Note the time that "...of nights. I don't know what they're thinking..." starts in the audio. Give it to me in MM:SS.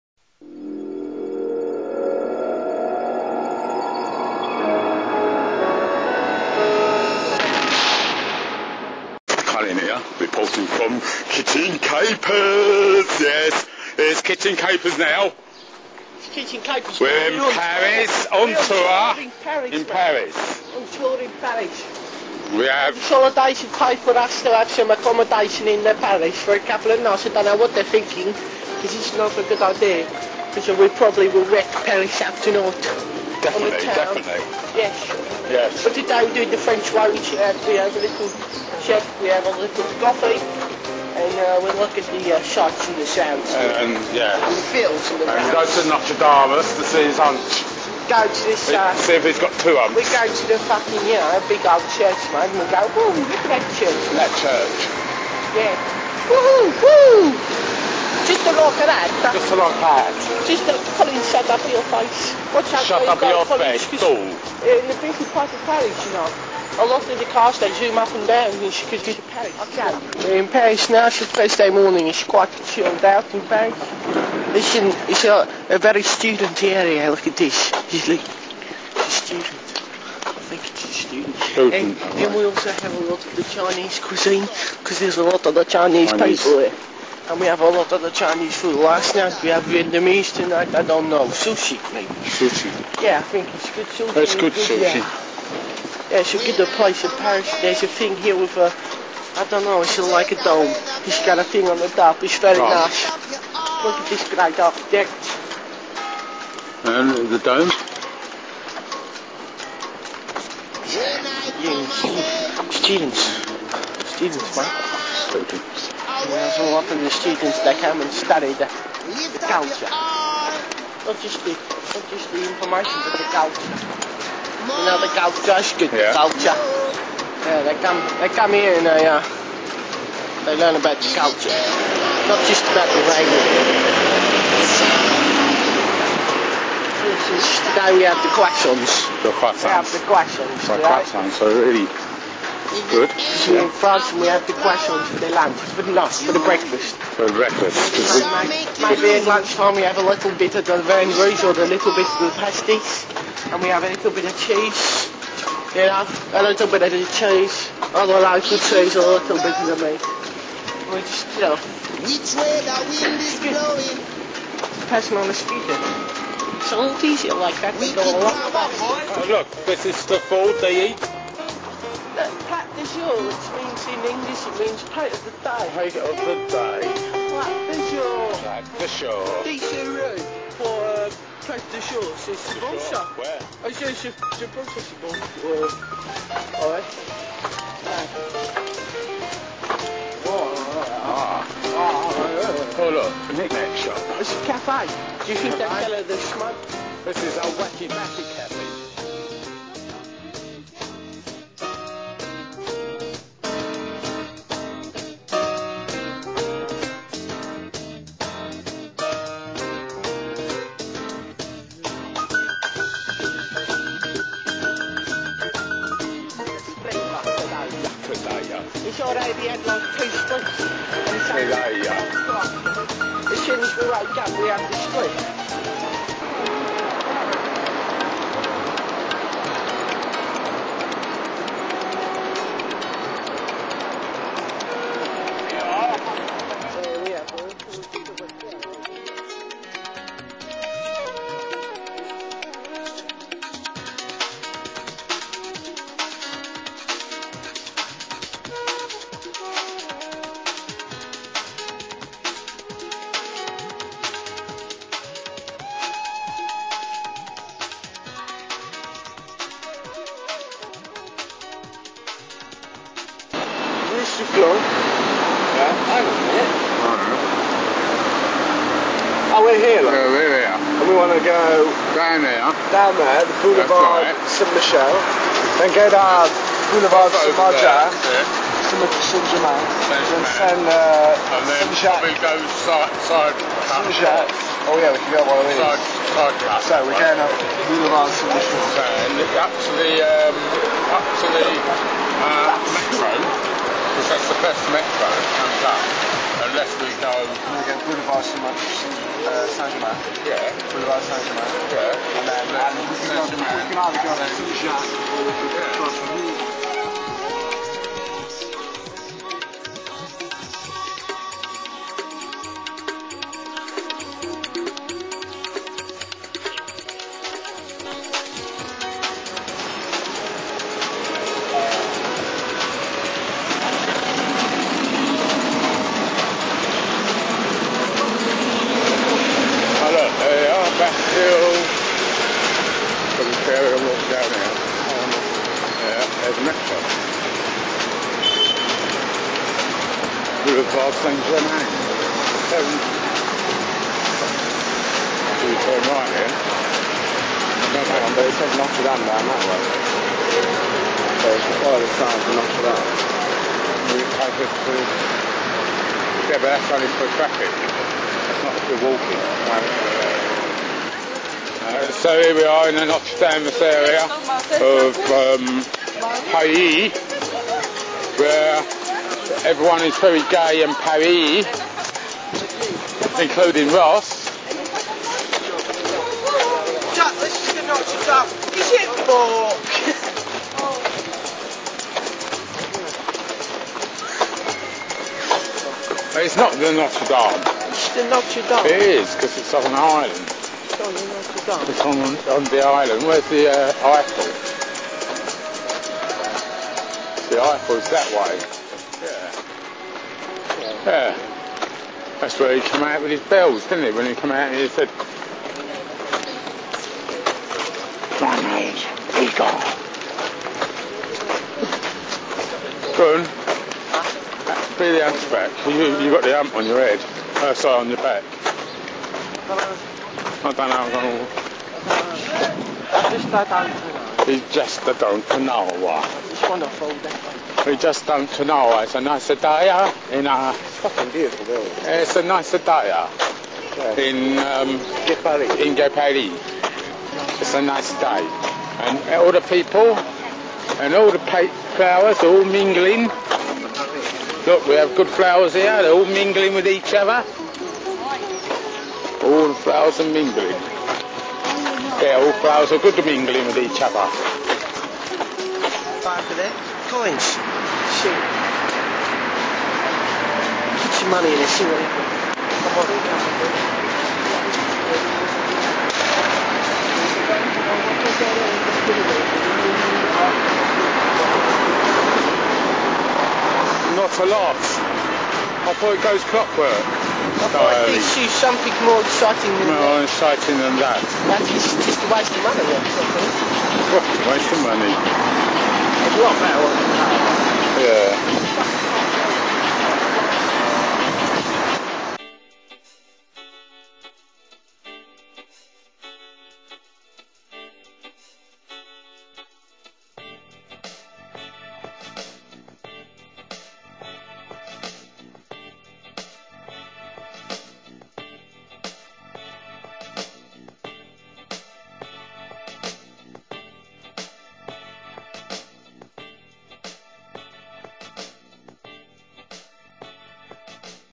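00:26.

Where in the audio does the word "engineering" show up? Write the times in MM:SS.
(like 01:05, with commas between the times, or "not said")
not said.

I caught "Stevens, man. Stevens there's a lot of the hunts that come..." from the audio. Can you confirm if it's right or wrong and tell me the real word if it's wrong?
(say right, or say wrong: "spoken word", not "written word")
wrong: "students", not "hunts".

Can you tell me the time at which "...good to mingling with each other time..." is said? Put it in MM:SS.
07:32.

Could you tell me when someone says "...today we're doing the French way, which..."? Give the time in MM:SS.
00:35.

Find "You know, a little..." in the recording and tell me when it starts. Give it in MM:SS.
02:35.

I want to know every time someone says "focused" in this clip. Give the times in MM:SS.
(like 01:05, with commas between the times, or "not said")
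not said.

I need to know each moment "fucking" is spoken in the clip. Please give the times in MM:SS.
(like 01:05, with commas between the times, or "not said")
00:50, 07:10.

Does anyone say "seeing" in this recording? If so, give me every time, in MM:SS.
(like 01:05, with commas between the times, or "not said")
not said.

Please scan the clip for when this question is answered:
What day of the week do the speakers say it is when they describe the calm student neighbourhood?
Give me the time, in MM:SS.
01:11.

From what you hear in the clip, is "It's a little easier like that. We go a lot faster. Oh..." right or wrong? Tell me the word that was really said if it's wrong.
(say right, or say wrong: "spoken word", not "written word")
right.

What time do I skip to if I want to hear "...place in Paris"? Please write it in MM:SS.
01:36.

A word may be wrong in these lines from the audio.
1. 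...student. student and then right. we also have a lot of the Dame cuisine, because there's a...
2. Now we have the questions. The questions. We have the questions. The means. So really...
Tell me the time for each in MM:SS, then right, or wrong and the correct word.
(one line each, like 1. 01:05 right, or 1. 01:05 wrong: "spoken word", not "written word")
1. 01:20 wrong: "Chinese", not "Dame"
2. 02:17 wrong: "questions", not "means".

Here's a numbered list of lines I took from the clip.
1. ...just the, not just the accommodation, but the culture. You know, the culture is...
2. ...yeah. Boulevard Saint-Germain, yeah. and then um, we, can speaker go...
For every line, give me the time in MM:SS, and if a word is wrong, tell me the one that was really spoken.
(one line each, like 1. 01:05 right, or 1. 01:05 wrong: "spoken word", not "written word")
1. 02:01 wrong: "information", not "accommodation"
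2. 05:00 wrong: "either", not "speaker".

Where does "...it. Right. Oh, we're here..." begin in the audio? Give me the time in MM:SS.
04:26.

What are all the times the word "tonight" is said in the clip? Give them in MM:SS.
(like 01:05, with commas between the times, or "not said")
00:32, 01:30.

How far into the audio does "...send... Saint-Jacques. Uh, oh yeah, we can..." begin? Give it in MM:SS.
04:40.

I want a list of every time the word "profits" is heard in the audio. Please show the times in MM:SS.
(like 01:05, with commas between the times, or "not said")
not said.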